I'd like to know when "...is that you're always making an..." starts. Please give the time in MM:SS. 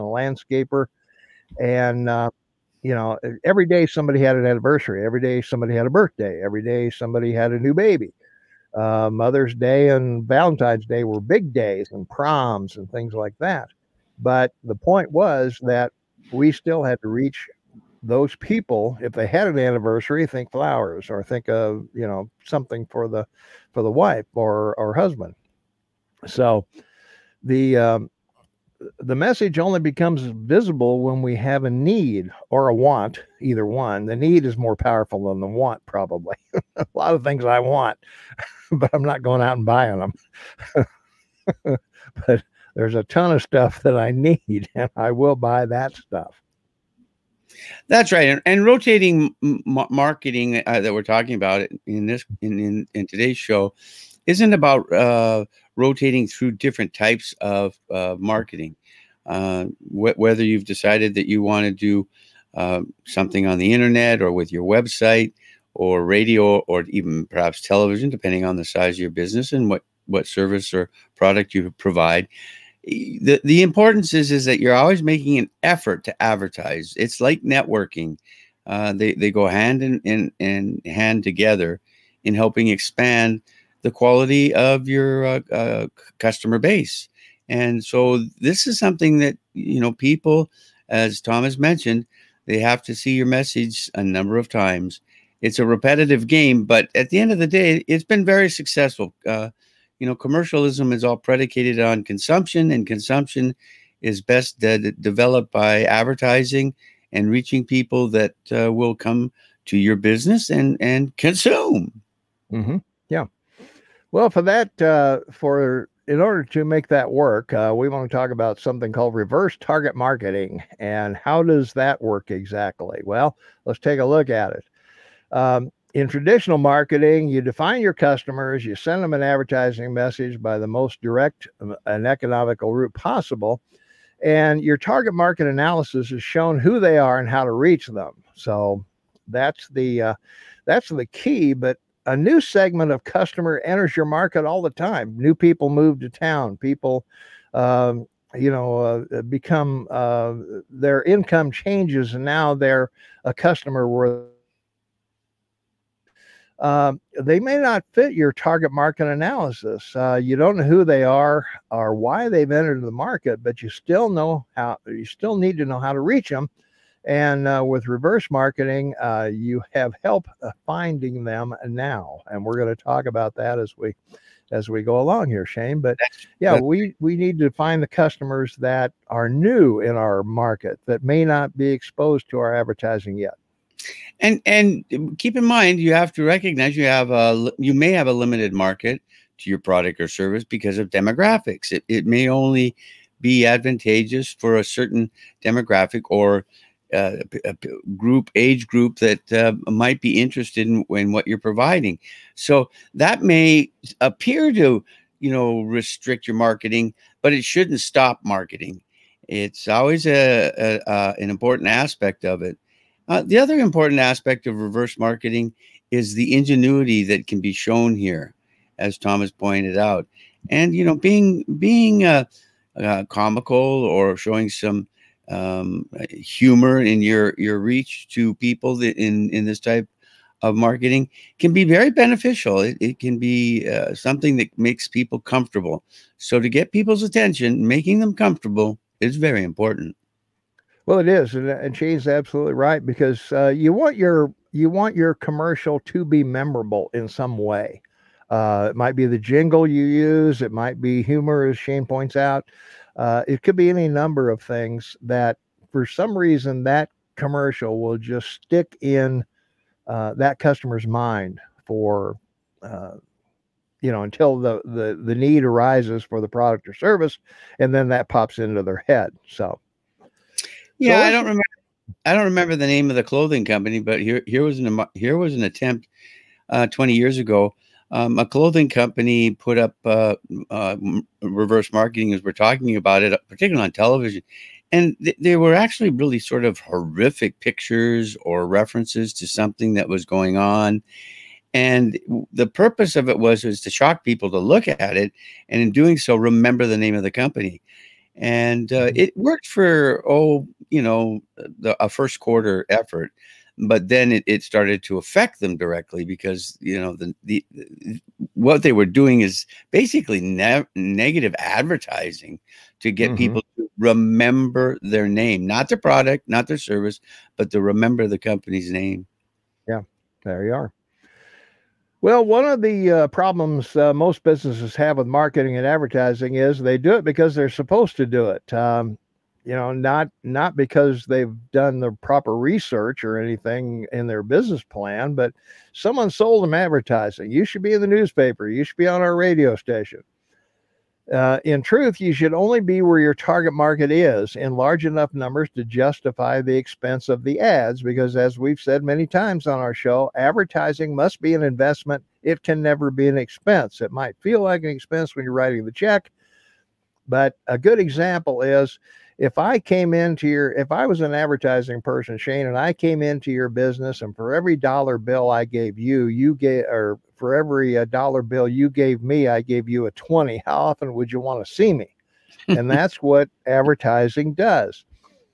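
01:14.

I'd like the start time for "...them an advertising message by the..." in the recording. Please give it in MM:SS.
02:09.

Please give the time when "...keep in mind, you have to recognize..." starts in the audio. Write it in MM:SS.
03:05.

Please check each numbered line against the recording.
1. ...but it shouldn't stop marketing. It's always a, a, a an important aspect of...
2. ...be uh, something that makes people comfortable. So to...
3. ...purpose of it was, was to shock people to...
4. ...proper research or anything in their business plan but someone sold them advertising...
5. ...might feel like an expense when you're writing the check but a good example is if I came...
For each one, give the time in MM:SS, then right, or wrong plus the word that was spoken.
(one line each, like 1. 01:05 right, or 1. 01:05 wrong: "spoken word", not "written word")
1. 03:27 right
2. 03:53 right
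3. 04:52 right
4. 05:32 right
5. 05:53 right.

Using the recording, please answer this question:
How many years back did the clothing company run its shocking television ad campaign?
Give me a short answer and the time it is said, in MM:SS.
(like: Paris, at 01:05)
20, at 04:36.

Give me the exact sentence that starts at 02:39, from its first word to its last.
Uh, you don't know who they are or why they've entered the market, but you still know how.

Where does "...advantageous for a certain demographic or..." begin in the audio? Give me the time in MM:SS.
03:13.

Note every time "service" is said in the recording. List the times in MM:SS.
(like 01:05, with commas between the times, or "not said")
01:10, 03:10, 04:26, 05:16.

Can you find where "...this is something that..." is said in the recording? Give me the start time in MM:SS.
01:28.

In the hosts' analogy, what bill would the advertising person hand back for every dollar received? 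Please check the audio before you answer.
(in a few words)
a 20.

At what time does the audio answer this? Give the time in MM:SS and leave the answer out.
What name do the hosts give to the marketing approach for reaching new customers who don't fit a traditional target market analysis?
01:59.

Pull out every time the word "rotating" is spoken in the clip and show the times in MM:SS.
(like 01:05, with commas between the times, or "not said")
00:48, 00:55.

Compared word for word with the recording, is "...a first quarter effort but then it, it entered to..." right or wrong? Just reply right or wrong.
wrong.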